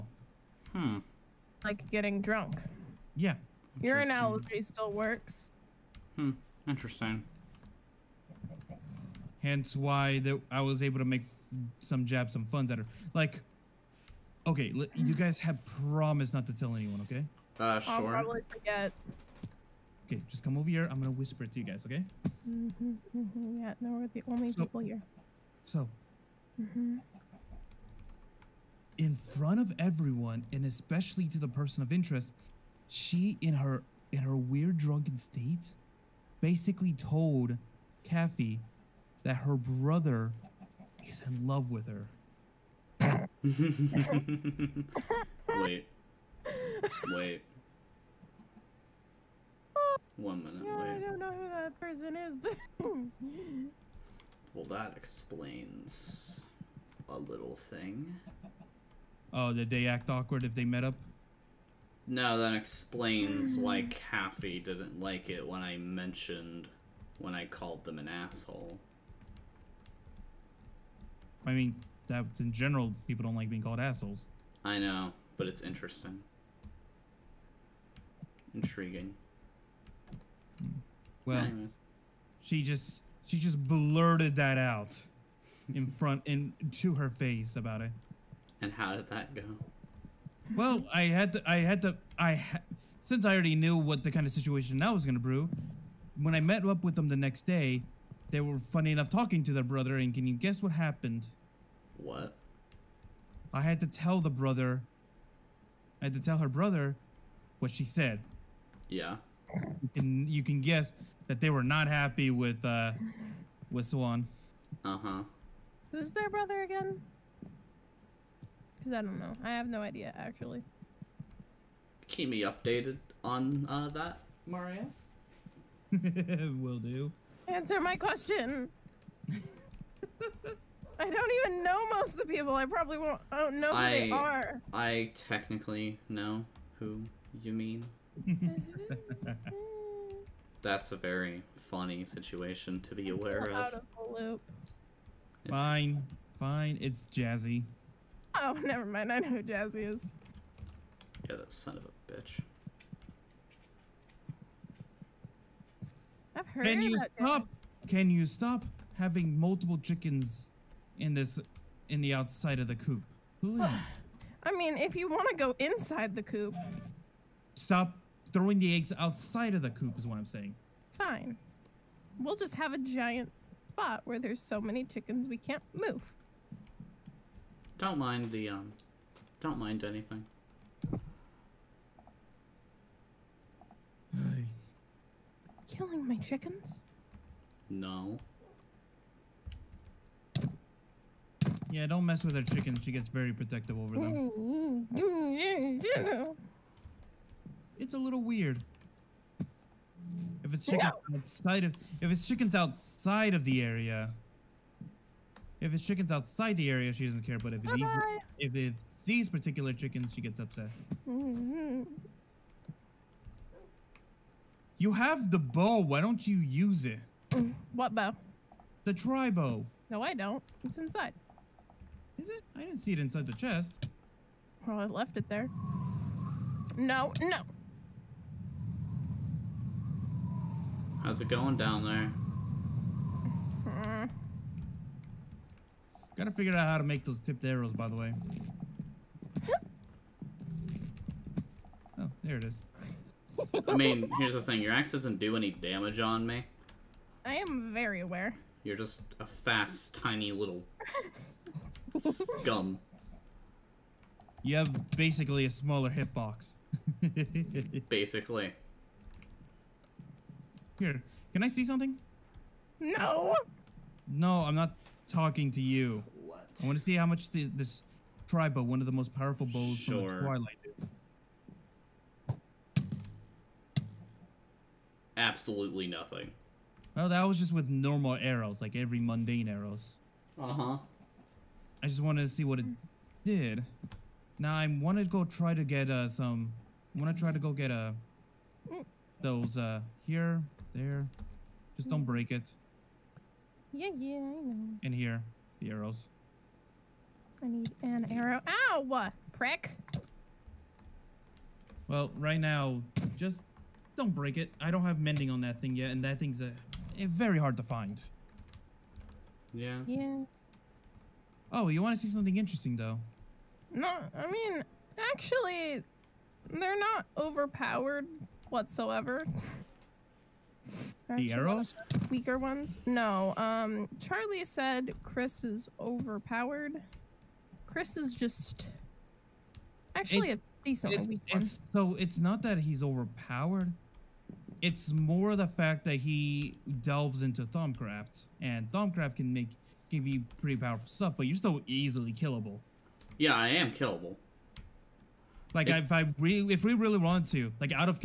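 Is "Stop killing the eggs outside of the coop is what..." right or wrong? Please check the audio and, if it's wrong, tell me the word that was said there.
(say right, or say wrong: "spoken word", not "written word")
wrong: "throwing", not "killing".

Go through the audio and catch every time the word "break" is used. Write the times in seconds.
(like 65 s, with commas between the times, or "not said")
292 s, 304 s.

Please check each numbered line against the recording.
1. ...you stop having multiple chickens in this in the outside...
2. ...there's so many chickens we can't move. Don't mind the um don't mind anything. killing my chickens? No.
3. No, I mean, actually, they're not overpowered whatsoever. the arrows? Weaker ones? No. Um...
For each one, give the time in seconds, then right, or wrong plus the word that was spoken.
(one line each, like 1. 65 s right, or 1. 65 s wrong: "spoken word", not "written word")
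1. 158 s right
2. 174 s right
3. 313 s right.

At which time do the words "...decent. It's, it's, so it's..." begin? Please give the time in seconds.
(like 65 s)
330 s.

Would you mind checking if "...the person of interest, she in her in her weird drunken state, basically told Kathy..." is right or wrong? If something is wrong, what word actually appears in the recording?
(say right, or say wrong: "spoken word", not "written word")
right.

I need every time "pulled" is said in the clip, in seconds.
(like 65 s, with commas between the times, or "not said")
not said.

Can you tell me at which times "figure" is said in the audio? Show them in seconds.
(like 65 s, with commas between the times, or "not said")
236 s.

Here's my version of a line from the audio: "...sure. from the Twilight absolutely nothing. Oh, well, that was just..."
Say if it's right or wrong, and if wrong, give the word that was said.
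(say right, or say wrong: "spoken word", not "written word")
right.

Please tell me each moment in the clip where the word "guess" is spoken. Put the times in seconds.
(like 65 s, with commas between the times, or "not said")
100 s, 110 s.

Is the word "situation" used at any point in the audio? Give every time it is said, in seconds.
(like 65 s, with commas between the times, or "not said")
94 s, 142 s.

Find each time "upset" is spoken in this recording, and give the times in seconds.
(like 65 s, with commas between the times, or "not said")
210 s.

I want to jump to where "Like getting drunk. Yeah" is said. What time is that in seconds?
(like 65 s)
1 s.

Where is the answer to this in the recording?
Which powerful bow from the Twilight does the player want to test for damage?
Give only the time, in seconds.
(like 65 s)
218 s.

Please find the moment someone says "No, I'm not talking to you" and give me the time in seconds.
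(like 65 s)
264 s.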